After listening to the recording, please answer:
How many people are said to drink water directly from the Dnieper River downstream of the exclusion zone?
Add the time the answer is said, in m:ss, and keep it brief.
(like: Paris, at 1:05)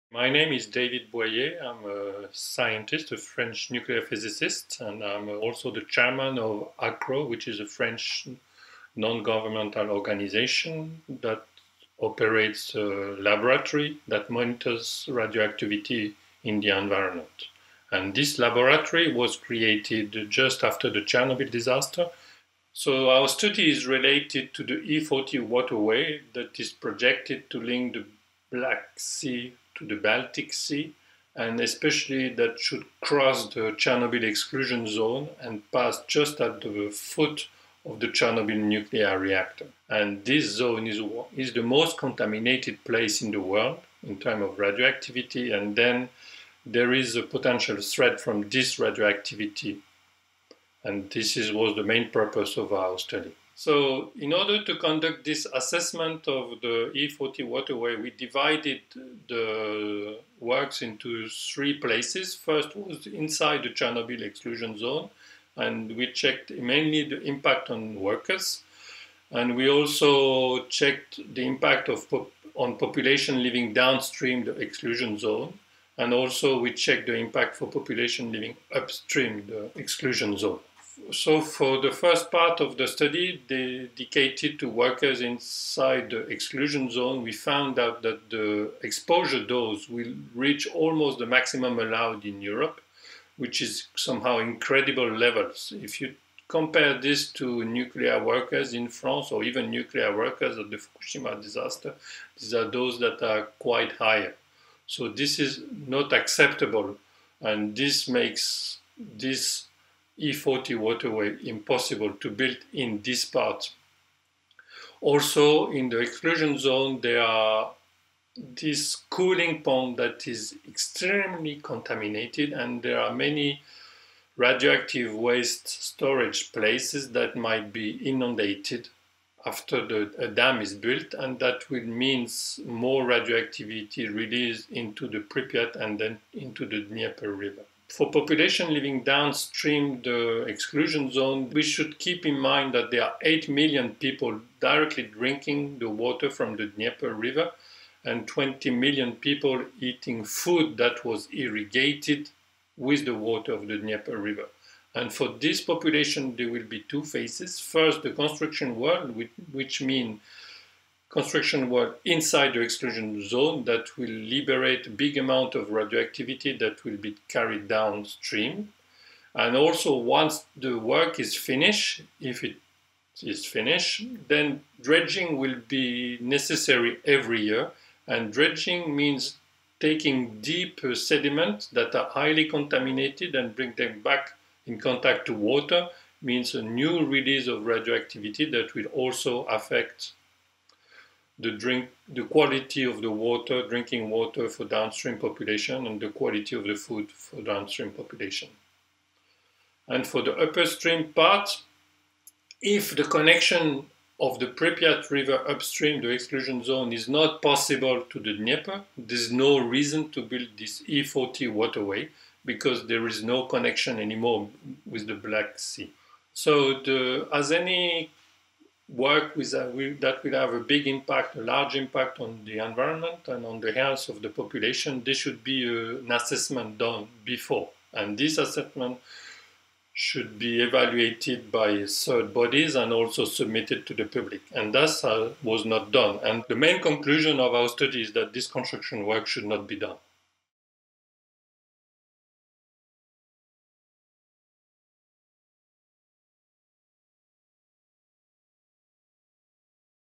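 8 million, at 2:23.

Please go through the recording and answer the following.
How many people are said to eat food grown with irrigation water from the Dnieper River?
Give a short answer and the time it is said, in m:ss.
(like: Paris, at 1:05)
20 million, at 2:28.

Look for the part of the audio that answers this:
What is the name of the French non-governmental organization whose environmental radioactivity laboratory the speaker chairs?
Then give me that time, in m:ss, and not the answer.
0:06.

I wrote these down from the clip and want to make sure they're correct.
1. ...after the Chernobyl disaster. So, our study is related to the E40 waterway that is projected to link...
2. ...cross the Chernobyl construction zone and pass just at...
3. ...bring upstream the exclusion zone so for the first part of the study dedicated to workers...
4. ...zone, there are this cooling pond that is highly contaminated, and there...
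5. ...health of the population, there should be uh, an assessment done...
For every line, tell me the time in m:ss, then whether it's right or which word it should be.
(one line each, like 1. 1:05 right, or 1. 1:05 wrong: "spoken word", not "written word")
1. 0:20 right
2. 0:33 wrong: "exclusion", not "construction"
3. 1:18 wrong: "living", not "bring"
4. 1:56 wrong: "extremely", not "highly"
5. 3:43 right.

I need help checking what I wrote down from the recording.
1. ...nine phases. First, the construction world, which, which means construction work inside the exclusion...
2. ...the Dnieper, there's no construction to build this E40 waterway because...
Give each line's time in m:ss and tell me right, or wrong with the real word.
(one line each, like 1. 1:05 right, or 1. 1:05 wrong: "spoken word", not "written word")
1. 2:36 wrong: "two", not "nine"
2. 3:28 wrong: "reason", not "construction".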